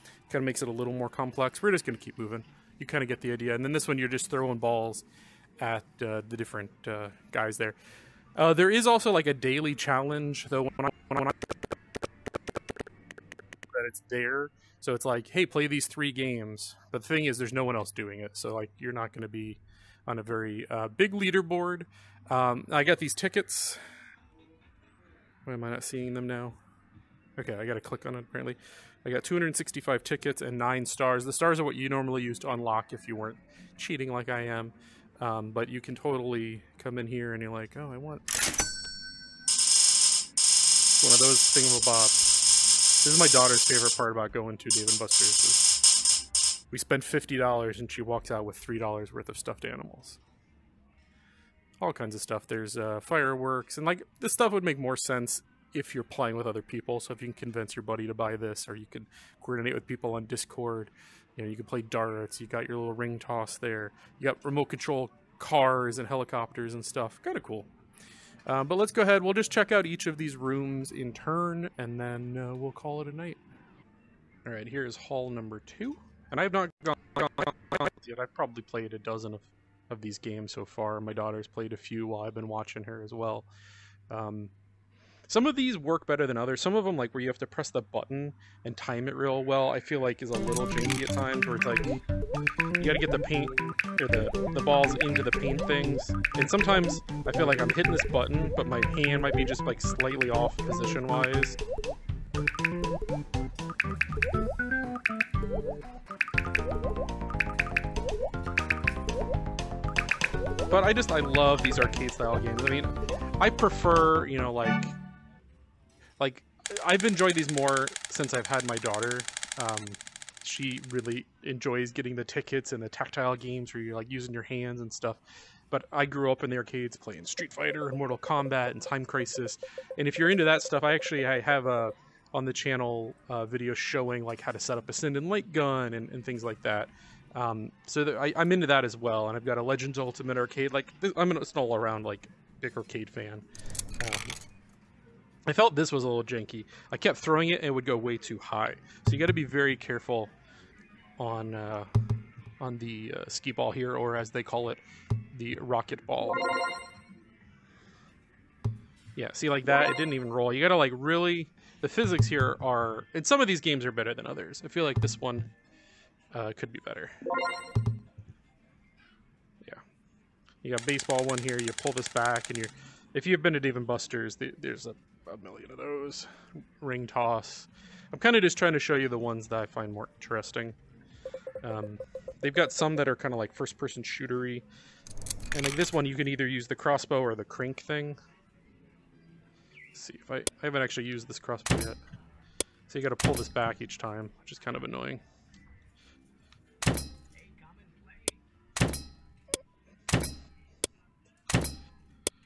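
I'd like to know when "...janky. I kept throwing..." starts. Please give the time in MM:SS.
02:26.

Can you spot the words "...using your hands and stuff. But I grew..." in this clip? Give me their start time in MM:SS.
02:04.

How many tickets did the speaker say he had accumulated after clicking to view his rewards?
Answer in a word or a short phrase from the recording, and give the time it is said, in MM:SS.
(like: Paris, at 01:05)
265, at 00:29.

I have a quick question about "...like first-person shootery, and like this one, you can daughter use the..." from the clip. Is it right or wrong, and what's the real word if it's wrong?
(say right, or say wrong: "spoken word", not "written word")
wrong: "either", not "daughter".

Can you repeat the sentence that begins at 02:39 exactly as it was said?
Yeah, see like that, it didn't even roll.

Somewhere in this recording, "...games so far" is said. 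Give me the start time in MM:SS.
01:20.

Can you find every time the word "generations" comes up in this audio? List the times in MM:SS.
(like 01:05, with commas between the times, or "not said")
not said.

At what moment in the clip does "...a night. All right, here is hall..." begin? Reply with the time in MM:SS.
01:13.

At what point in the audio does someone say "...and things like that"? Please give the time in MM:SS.
02:16.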